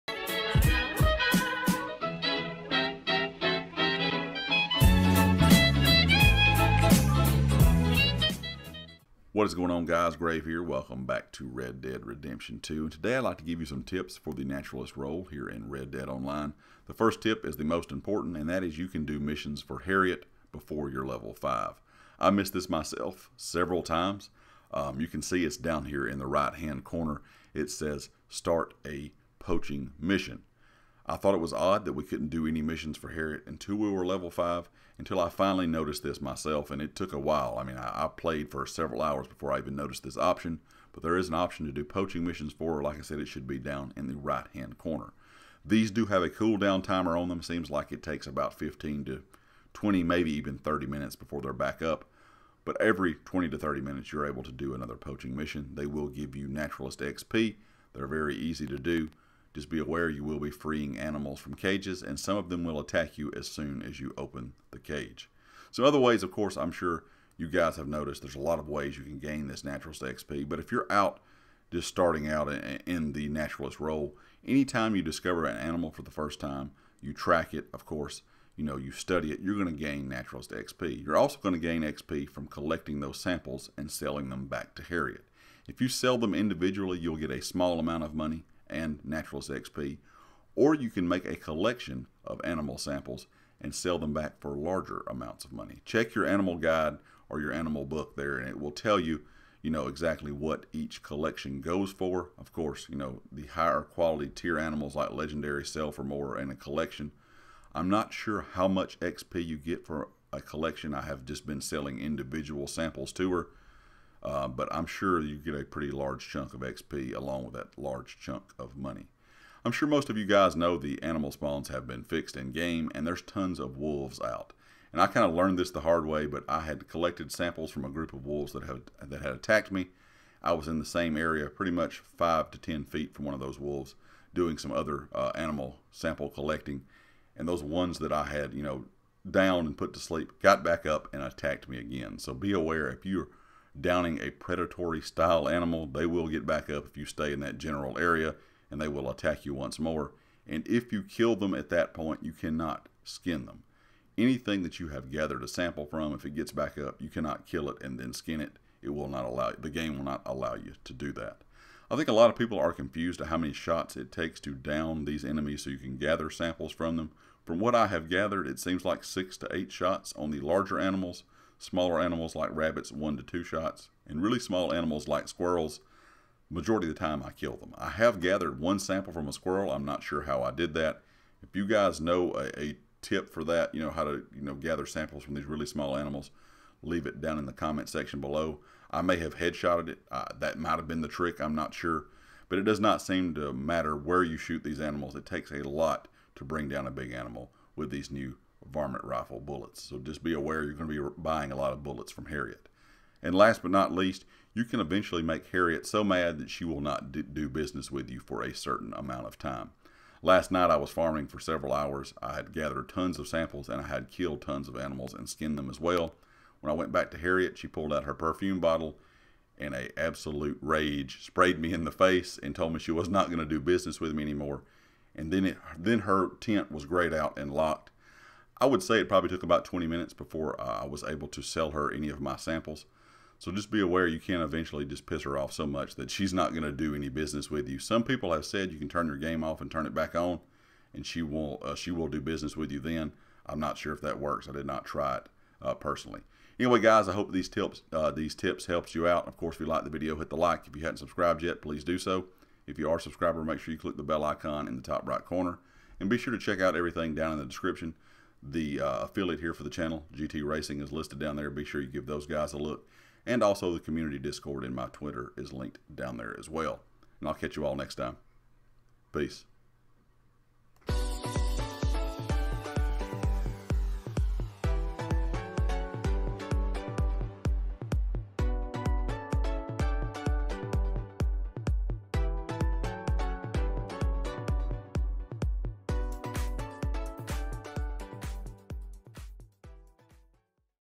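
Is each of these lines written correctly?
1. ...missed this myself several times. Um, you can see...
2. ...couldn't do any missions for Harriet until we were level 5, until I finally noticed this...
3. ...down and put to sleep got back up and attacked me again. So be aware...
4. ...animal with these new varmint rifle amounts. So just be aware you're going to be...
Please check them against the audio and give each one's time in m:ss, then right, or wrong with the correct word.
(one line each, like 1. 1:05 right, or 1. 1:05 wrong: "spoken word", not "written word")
1. 0:22 right
2. 0:32 right
3. 2:19 right
4. 3:17 wrong: "bullets", not "amounts".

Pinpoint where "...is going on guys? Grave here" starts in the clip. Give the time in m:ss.
0:09.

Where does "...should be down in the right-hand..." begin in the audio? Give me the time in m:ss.
0:43.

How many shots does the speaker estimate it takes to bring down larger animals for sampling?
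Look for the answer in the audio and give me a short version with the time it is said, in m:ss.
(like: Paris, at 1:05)
6 to 8, at 2:49.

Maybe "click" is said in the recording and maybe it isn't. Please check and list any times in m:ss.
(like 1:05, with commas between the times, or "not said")
4:13.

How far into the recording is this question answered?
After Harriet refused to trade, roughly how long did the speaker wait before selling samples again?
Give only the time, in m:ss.
3:49.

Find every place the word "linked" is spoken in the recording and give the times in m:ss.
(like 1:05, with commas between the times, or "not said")
4:25.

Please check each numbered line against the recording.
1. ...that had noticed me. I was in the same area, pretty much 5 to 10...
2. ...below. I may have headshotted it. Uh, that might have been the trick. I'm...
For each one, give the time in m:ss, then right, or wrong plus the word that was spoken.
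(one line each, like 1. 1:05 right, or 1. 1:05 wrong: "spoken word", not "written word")
1. 2:09 wrong: "attacked", not "noticed"
2. 3:08 right.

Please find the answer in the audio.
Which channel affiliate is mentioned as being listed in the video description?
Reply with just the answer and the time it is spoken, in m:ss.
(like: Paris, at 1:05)
GT Racing, at 4:20.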